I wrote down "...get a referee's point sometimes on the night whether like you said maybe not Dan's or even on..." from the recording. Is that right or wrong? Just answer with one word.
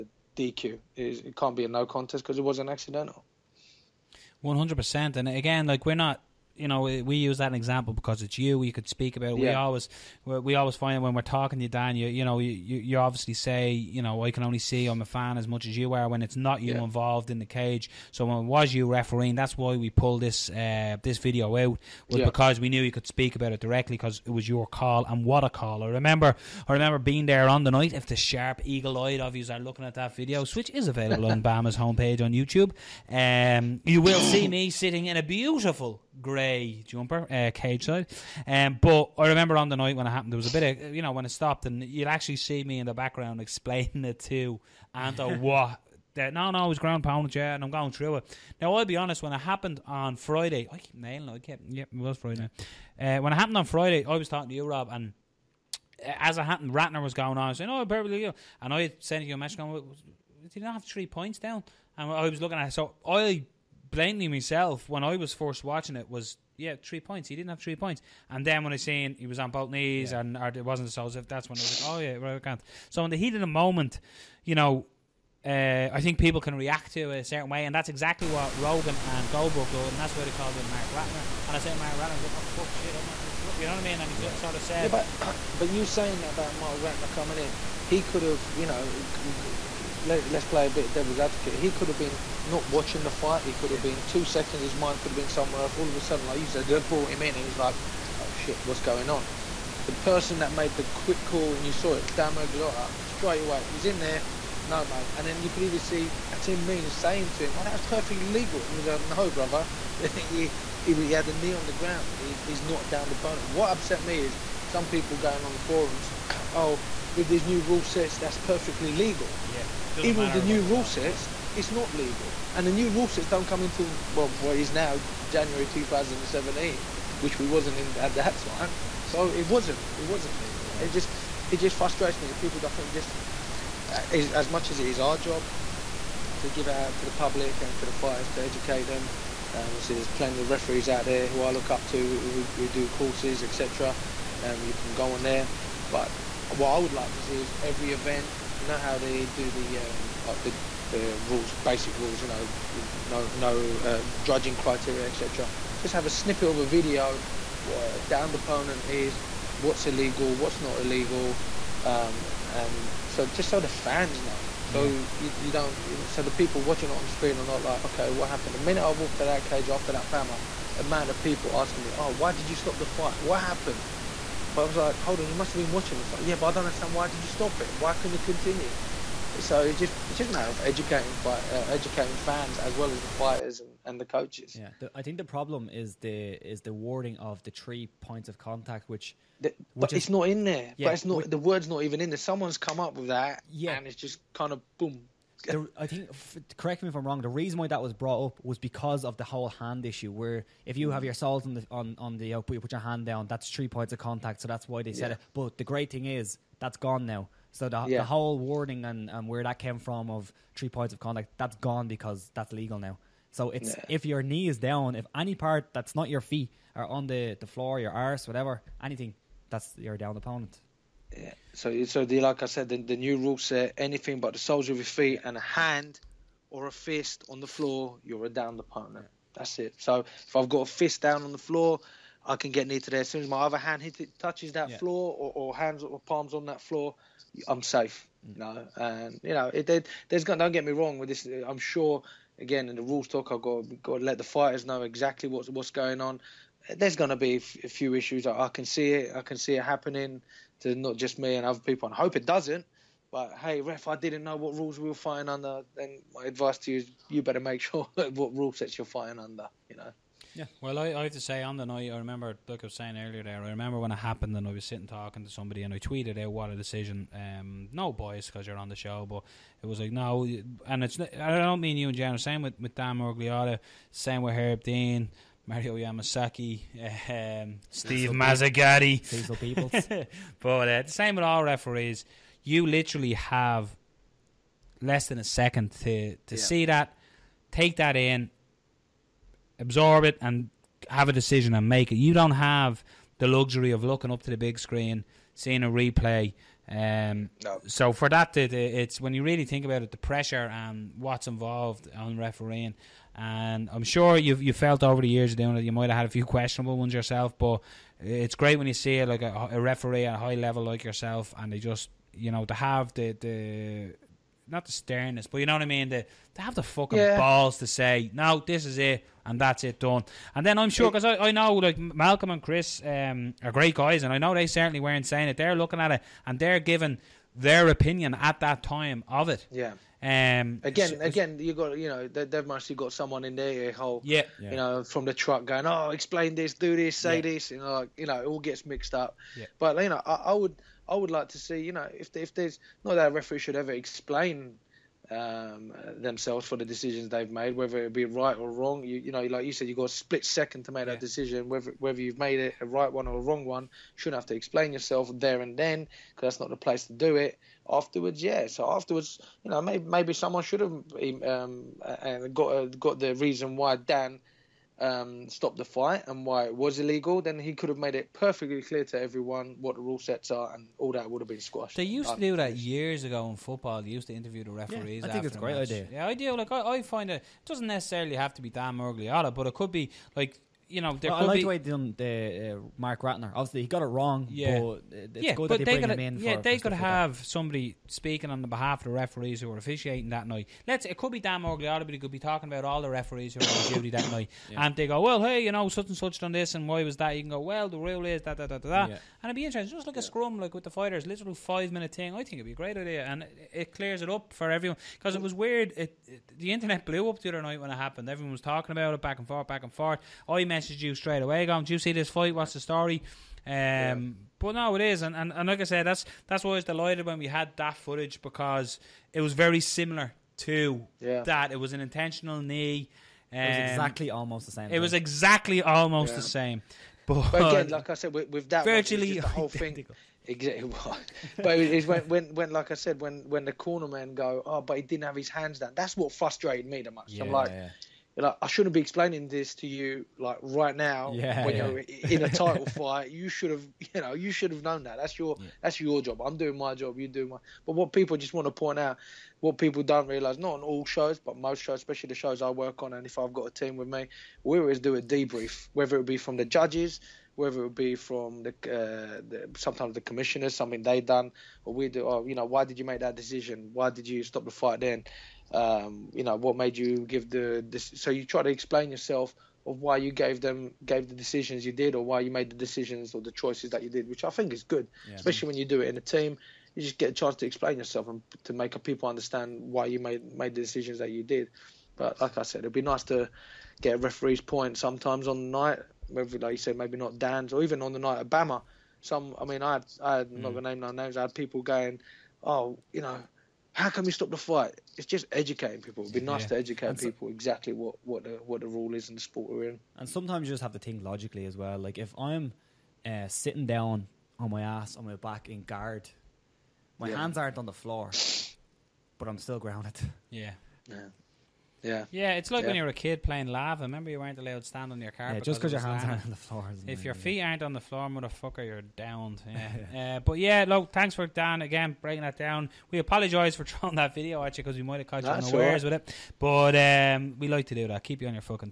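right.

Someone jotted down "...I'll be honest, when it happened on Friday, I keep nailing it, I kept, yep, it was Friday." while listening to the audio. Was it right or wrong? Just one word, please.
right.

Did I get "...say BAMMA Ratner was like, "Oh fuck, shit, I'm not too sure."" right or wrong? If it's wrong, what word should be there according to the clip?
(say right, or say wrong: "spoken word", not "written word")
wrong: "Mark", not "BAMMA".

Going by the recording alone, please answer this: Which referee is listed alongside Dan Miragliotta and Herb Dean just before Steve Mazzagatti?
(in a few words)
Mario Yamasaki.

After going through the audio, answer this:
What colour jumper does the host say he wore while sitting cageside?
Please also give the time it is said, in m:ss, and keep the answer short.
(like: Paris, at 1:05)
Grey, at 0:36.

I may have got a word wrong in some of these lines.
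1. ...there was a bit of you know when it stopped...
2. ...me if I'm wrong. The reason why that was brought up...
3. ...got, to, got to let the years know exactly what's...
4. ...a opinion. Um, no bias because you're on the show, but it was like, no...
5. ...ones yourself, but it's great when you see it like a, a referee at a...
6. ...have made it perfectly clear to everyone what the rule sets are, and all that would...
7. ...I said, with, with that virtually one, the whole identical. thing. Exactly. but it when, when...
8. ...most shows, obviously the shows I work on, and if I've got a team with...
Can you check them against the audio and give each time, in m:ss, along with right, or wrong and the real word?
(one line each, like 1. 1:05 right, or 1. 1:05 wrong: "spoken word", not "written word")
1. 0:40 right
2. 3:16 right
3. 4:03 wrong: "fighters", not "years"
4. 4:26 wrong: "decision", not "opinion"
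5. 5:06 right
6. 6:07 right
7. 7:07 right
8. 7:31 wrong: "especially", not "obviously".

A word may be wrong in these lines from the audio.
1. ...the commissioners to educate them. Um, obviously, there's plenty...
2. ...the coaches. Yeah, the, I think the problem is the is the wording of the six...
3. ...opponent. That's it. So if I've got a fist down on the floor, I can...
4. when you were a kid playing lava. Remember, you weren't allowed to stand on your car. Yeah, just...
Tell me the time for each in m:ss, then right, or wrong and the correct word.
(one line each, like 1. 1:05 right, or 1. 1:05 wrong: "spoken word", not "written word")
1. 2:17 wrong: "fighters", not "commissioners"
2. 3:03 wrong: "three", not "six"
3. 3:48 right
4. 8:32 right.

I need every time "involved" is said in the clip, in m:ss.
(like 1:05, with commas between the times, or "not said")
0:16, 5:01.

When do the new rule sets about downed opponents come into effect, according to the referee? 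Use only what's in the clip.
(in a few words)
January 2017.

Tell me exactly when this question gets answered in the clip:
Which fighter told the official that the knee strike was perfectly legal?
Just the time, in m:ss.
1:46.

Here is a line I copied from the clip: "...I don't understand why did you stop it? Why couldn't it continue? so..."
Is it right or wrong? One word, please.
right.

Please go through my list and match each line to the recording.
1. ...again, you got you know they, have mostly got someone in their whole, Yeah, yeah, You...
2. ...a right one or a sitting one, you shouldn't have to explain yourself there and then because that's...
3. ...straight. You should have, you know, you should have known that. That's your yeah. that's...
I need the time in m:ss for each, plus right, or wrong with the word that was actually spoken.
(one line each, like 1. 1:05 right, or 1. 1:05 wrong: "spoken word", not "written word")
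1. 5:30 right
2. 5:52 wrong: "wrong", not "sitting"
3. 7:22 wrong: "fight", not "straight".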